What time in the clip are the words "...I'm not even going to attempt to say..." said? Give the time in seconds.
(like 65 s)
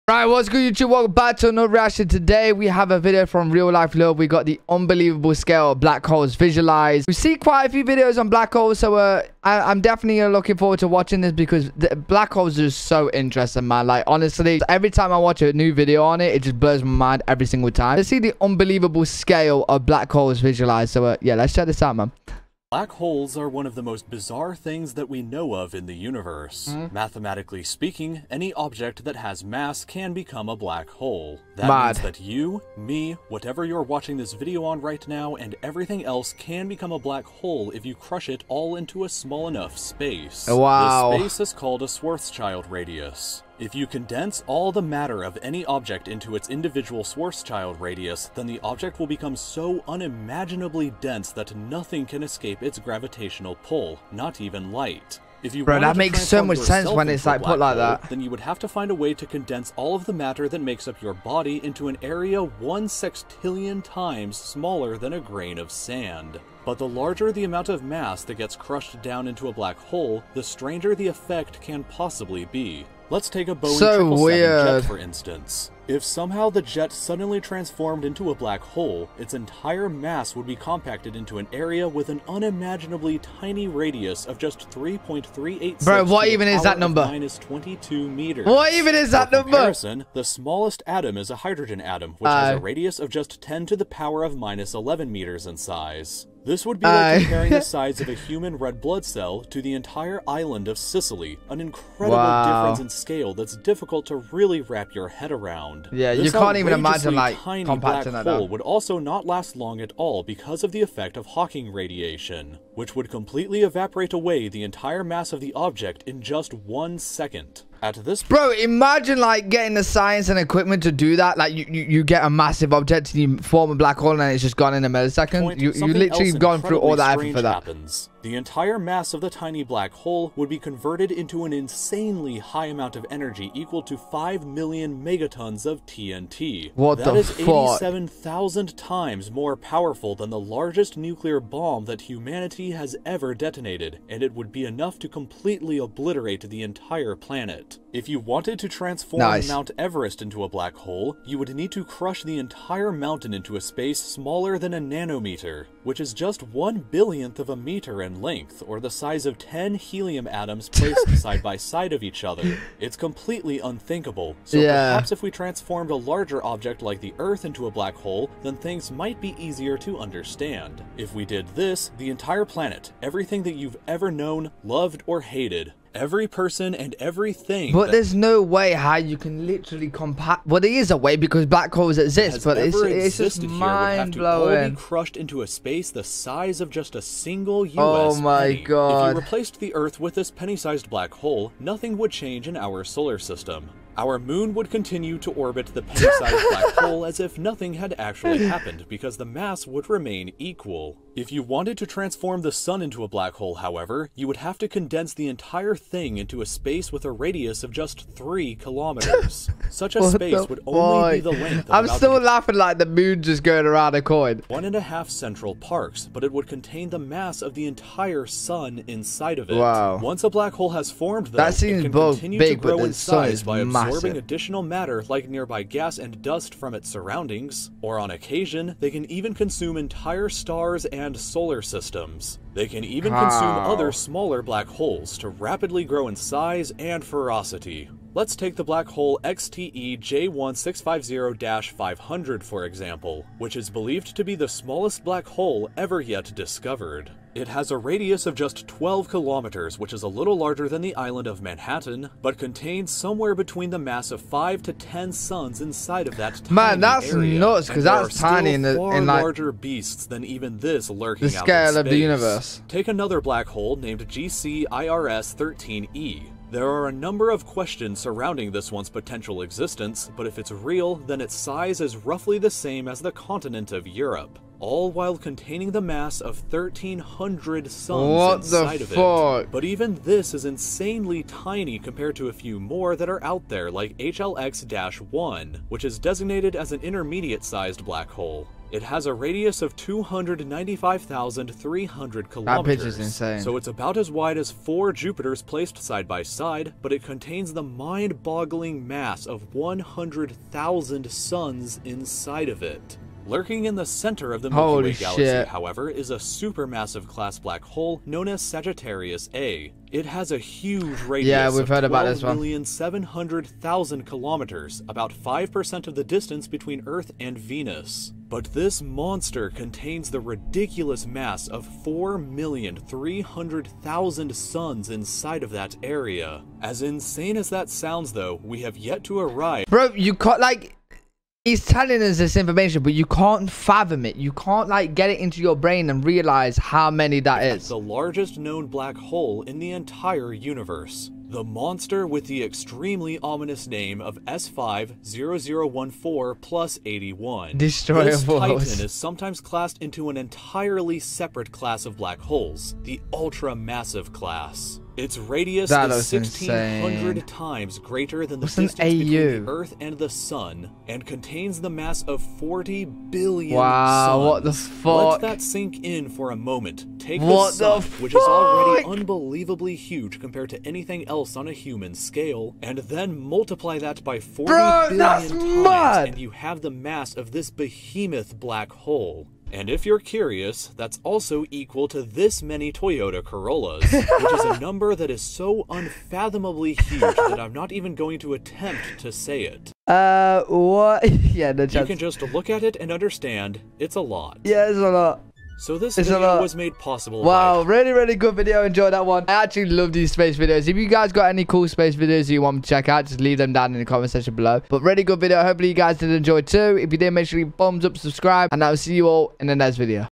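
387 s.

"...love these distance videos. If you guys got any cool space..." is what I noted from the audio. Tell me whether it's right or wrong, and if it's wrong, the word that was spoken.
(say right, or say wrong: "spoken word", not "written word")
wrong: "space", not "distance".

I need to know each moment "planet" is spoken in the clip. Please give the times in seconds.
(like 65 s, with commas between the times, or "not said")
147 s, 172 s.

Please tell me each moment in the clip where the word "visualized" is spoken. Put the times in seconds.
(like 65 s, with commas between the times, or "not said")
6 s, 20 s.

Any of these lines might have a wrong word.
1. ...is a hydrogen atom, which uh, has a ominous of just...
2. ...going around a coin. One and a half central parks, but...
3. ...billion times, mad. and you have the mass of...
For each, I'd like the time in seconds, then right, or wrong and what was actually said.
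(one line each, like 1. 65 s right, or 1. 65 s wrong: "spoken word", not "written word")
1. 91 s wrong: "radius", not "ominous"
2. 213 s right
3. 374 s right.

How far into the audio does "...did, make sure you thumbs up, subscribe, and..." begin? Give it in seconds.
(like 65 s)
406 s.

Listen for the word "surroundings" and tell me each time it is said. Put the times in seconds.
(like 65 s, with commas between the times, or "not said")
226 s, 268 s.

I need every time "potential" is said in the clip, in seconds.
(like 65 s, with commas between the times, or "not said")
268 s.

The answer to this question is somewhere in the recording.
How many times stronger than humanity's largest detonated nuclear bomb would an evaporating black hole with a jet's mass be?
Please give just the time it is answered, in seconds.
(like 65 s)
137 s.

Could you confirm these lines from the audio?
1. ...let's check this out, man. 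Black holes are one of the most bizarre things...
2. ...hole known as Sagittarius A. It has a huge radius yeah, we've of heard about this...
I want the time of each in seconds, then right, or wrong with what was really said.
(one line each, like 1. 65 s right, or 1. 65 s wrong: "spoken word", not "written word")
1. 21 s right
2. 307 s right.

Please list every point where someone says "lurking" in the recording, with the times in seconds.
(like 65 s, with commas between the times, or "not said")
260 s, 303 s.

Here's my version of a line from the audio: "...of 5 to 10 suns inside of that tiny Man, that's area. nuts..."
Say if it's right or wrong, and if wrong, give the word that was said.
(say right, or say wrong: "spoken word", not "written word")
right.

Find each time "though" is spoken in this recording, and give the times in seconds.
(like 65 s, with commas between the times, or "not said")
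221 s, 328 s.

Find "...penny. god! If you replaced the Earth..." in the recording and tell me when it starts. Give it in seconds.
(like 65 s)
188 s.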